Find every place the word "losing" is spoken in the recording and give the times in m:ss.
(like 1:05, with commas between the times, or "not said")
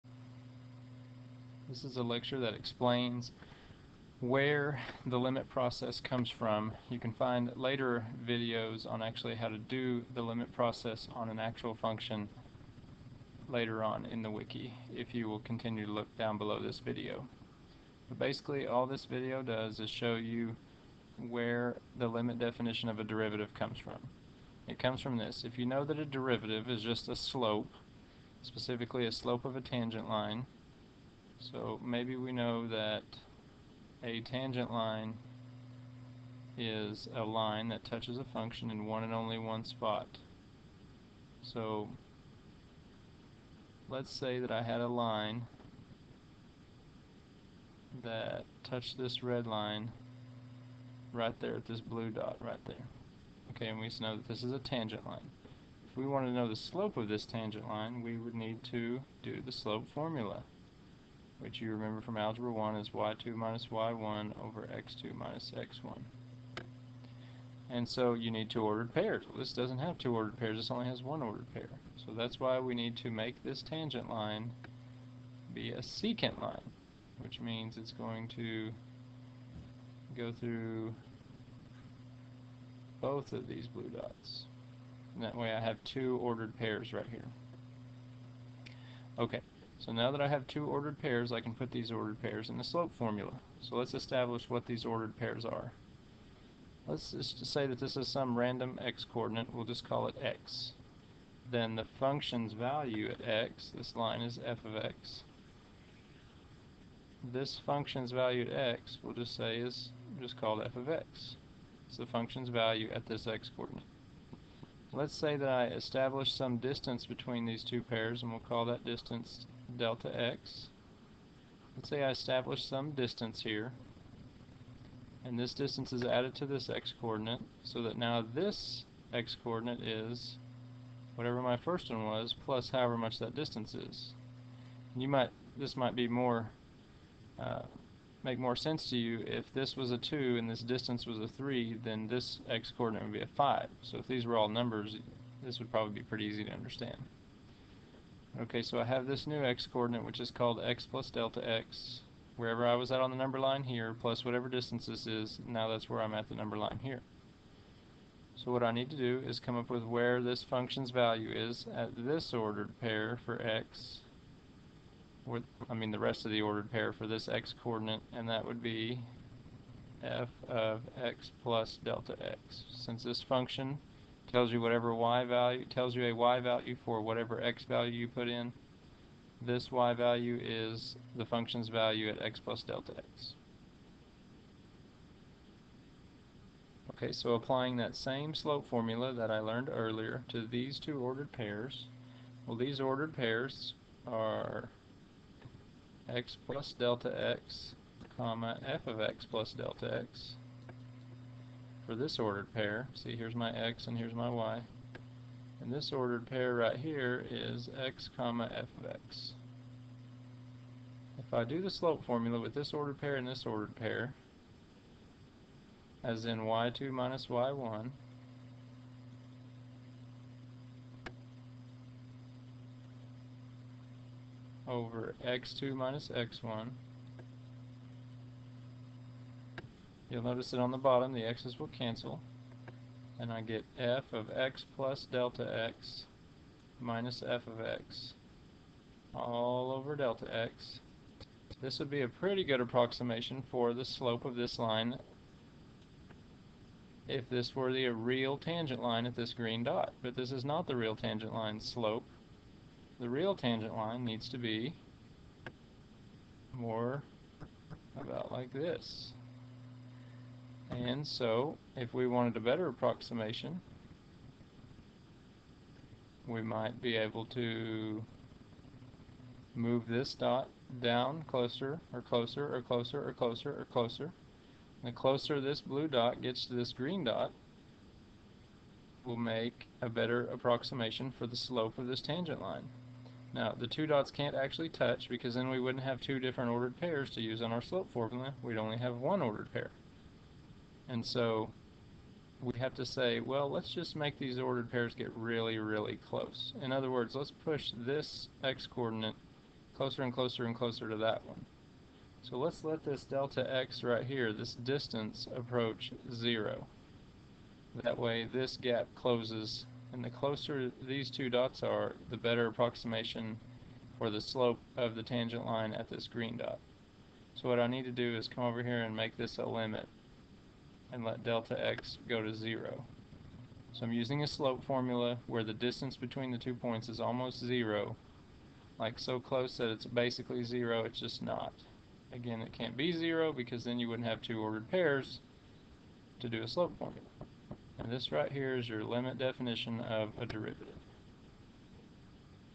not said.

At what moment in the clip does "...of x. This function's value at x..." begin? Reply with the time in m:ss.
1:44.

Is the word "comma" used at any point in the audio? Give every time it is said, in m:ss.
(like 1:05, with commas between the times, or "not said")
3:18, 3:28.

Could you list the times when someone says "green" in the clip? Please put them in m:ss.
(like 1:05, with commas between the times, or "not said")
4:09, 4:36, 5:16.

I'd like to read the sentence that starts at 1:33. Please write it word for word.
So let's establish what these ordered pairs are.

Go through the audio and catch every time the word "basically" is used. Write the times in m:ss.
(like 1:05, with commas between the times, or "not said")
0:18, 5:29.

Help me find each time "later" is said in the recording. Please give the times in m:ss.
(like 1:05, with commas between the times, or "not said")
0:07, 0:13.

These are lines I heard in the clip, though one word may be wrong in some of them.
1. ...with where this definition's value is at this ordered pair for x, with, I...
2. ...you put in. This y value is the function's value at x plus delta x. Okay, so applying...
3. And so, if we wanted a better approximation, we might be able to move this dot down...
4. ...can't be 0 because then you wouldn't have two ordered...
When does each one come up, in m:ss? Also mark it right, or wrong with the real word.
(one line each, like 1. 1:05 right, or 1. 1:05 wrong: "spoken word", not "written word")
1. 2:39 wrong: "function", not "definition"
2. 2:57 right
3. 4:20 right
4. 5:32 right.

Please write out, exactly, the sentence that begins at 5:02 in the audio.
So let's let this delta x right here, this distance, approach 0.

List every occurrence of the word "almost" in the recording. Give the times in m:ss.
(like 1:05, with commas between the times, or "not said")
5:26.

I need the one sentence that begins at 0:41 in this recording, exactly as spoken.
So let's say that I had a line that touched this red line right there at this blue dot right there.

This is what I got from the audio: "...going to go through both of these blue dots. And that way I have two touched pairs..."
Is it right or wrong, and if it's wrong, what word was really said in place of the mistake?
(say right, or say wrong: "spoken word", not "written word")
wrong: "ordered", not "touched".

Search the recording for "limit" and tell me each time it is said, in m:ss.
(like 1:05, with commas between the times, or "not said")
0:05, 0:10, 0:22, 5:19, 5:38.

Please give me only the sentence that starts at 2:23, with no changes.
So if these were all numbers, this would probably be pretty easy to understand.